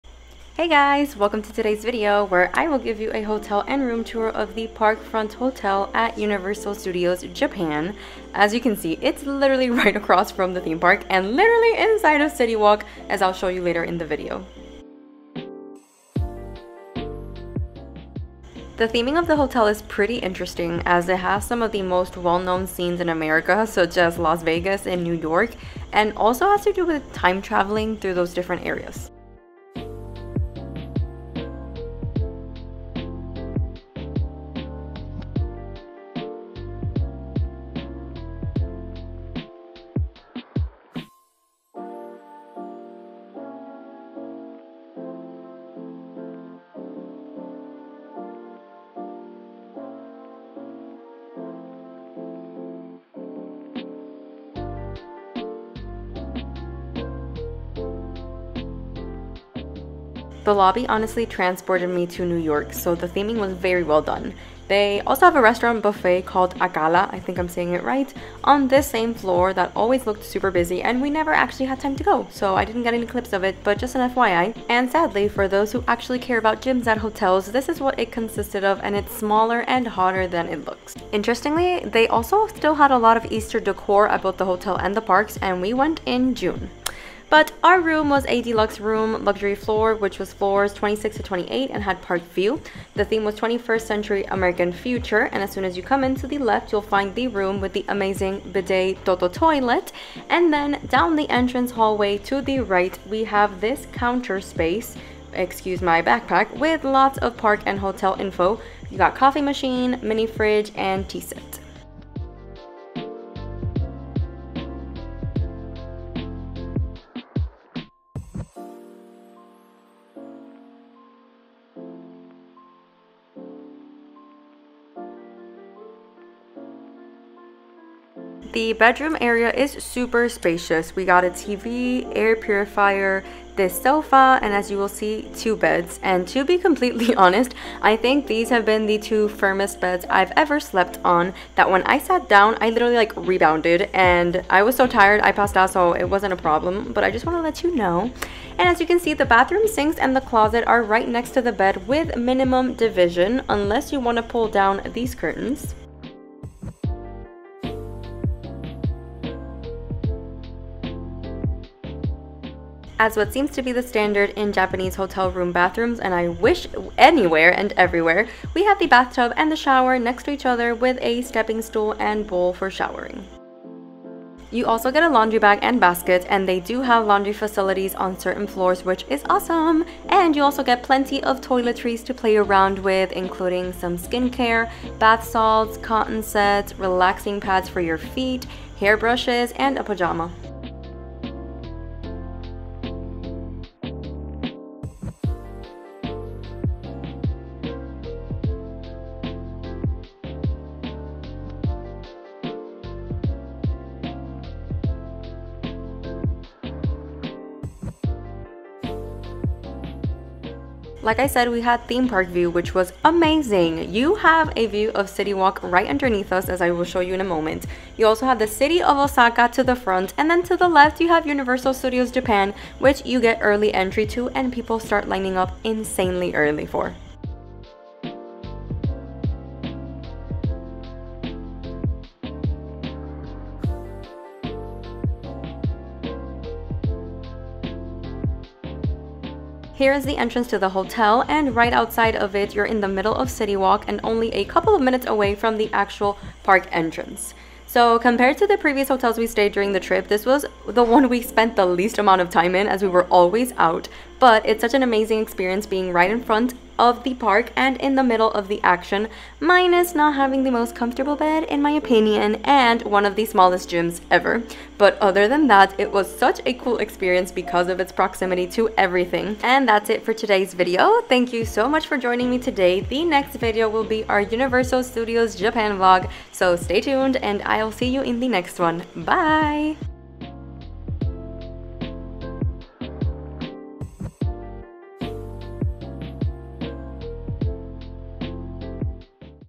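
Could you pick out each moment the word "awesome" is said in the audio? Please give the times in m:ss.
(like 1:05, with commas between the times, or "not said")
2:59.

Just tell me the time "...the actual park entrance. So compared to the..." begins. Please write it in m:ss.
4:05.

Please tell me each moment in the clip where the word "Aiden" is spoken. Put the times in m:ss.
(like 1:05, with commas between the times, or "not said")
not said.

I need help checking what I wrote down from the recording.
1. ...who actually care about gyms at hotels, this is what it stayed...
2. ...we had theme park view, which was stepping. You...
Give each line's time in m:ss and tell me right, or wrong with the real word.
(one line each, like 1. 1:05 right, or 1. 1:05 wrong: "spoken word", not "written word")
1. 1:15 wrong: "consisted", not "stayed"
2. 3:31 wrong: "amazing", not "stepping".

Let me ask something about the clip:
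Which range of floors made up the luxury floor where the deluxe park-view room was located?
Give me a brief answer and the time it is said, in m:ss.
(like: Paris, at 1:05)
26 to 28, at 1:30.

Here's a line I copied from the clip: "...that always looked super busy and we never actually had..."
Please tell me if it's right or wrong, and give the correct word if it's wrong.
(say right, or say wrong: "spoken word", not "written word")
right.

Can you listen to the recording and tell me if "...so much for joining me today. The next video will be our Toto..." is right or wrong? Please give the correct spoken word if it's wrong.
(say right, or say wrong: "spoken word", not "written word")
wrong: "Universal", not "Toto".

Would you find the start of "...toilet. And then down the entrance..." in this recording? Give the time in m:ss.
1:39.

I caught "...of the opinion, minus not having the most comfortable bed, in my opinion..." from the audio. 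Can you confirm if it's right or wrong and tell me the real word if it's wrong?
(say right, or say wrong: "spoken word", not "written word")
wrong: "action", not "opinion".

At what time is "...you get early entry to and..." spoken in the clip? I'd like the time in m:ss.
3:43.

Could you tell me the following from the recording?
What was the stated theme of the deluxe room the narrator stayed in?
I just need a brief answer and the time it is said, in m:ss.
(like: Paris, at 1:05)
21st century American future, at 1:33.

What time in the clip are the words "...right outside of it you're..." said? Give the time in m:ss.
4:01.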